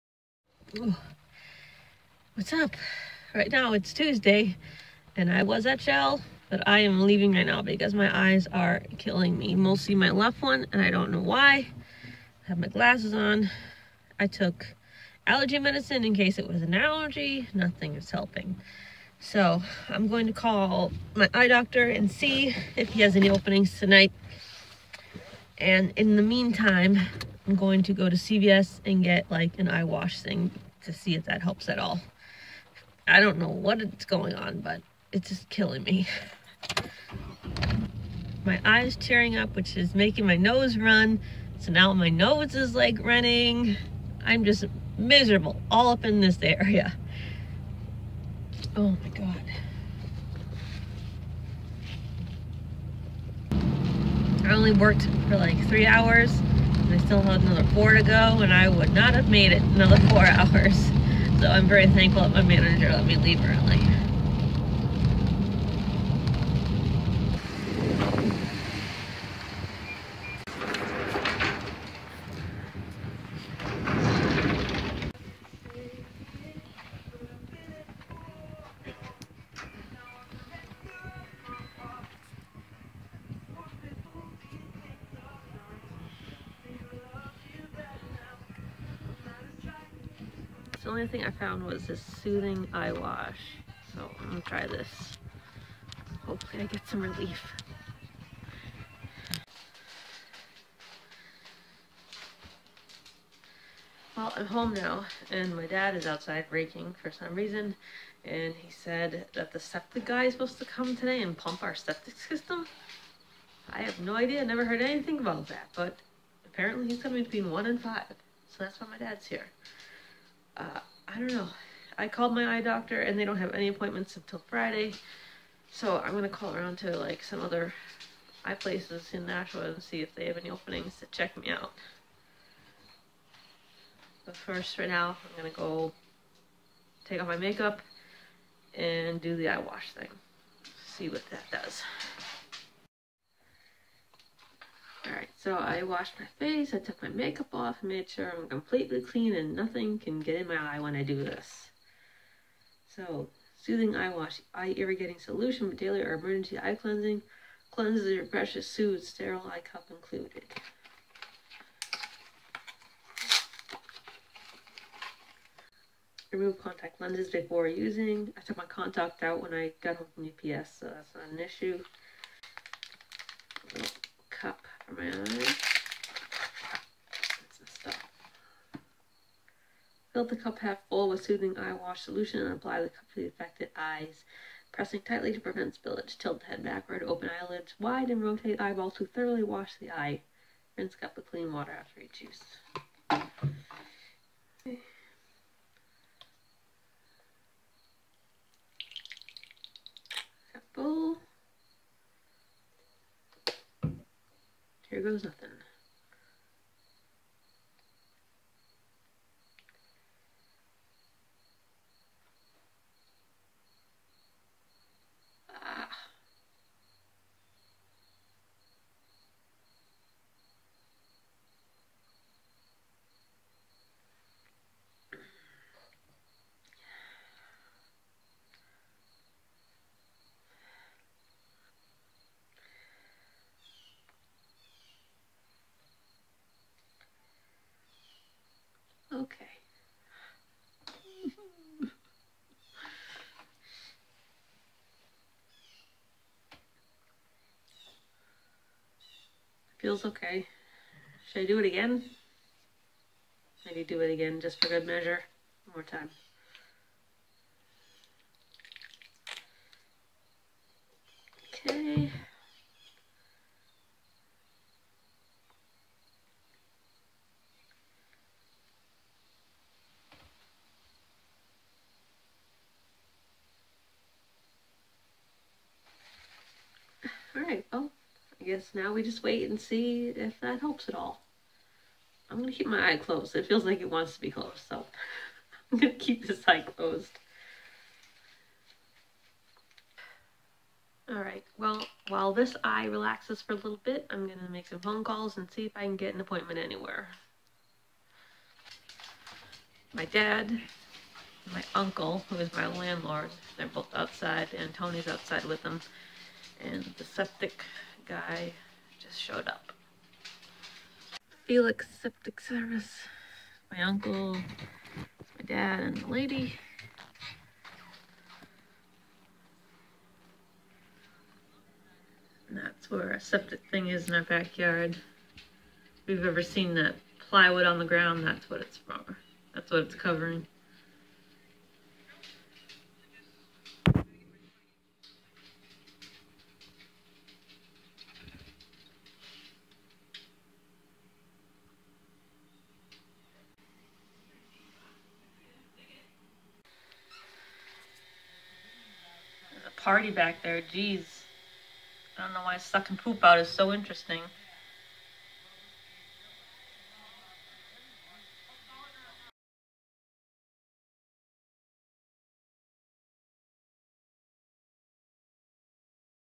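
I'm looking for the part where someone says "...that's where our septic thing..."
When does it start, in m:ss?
5:22.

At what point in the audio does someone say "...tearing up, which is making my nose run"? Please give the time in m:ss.
0:38.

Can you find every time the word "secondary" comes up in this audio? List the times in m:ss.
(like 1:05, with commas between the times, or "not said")
not said.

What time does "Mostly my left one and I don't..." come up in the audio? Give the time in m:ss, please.
0:09.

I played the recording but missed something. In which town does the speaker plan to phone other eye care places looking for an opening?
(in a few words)
Nashua.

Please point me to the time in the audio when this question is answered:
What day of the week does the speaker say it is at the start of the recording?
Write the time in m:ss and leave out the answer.
0:03.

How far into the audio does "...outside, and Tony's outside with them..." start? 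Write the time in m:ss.
5:03.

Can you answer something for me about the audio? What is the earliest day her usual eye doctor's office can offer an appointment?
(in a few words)
Friday.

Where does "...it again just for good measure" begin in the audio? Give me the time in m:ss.
4:13.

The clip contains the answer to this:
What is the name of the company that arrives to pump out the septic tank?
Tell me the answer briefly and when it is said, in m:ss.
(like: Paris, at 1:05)
Felix Septic Service, at 5:11.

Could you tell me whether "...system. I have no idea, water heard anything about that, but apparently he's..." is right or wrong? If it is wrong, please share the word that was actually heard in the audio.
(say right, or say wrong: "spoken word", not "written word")
wrong: "never", not "water".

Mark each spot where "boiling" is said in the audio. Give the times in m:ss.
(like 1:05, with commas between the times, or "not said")
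not said.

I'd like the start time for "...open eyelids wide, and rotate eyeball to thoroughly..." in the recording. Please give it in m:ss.
3:07.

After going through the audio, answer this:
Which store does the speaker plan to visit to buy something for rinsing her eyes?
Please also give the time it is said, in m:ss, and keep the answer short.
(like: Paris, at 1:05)
CVS, at 0:28.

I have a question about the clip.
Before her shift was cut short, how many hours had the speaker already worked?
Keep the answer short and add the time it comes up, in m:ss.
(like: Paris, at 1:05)
3, at 0:55.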